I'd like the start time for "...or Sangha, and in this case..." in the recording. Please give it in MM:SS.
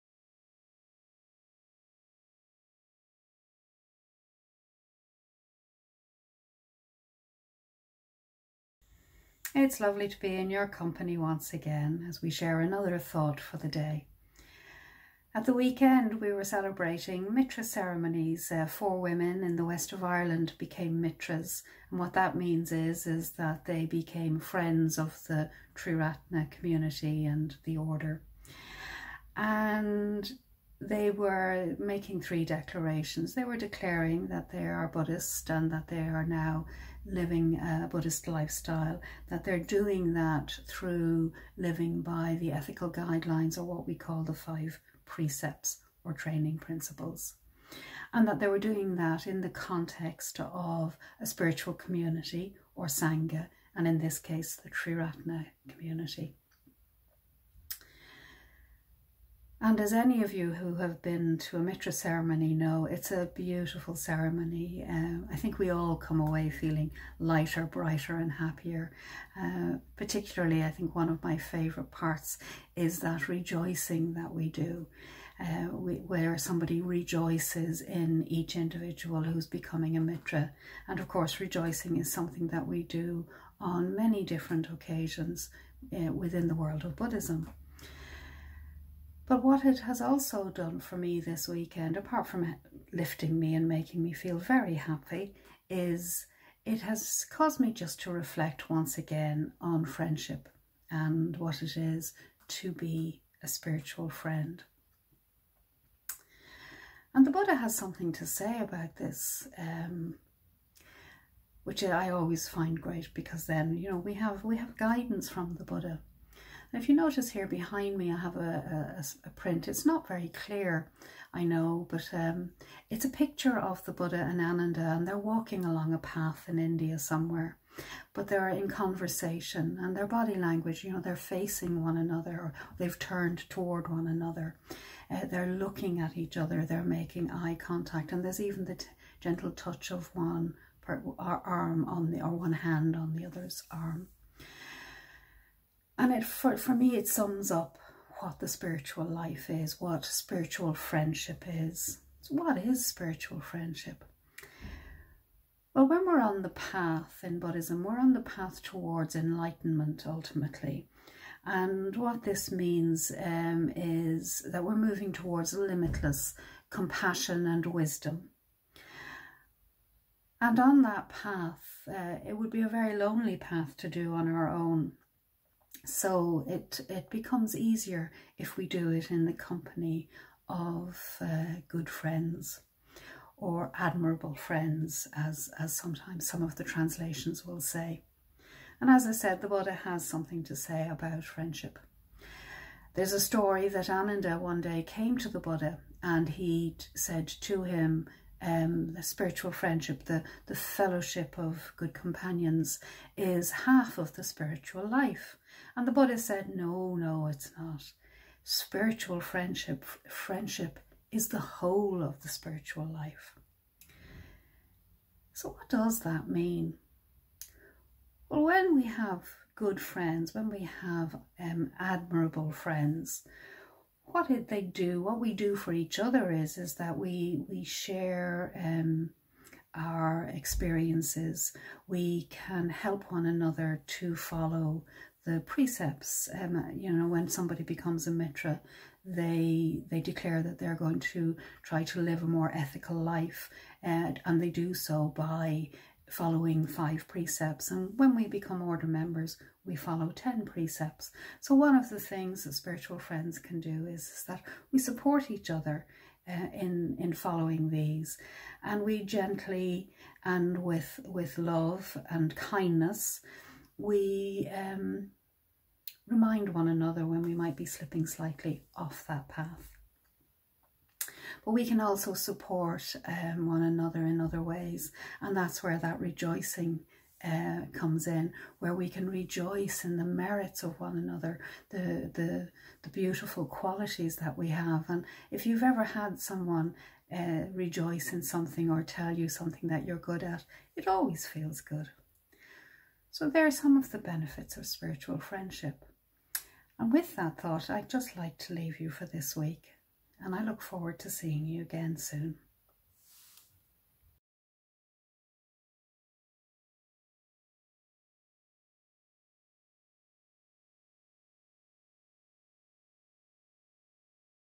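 00:52.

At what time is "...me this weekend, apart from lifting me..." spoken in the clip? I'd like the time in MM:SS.
01:30.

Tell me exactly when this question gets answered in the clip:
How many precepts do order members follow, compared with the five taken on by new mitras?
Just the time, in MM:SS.
04:10.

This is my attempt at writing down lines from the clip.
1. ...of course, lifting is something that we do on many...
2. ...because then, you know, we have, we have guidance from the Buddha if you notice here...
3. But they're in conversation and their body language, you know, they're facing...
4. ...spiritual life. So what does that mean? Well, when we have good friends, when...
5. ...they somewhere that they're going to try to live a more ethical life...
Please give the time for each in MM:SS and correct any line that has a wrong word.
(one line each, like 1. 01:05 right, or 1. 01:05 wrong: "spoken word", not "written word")
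1. 01:20 wrong: "rejoicing", not "lifting"
2. 01:53 right
3. 02:08 right
4. 03:32 right
5. 03:59 wrong: "declare", not "somewhere".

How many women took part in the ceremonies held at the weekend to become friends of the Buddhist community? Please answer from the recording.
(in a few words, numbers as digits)
4.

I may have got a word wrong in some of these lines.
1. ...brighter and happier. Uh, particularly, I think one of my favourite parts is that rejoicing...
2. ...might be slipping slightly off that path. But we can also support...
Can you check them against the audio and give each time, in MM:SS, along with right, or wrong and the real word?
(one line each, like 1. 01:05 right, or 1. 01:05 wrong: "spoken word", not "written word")
1. 01:07 right
2. 04:27 right.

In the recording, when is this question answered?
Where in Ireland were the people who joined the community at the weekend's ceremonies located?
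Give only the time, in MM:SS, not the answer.
00:19.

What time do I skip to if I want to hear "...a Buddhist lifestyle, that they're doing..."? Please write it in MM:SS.
00:37.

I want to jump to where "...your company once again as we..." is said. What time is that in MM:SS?
00:10.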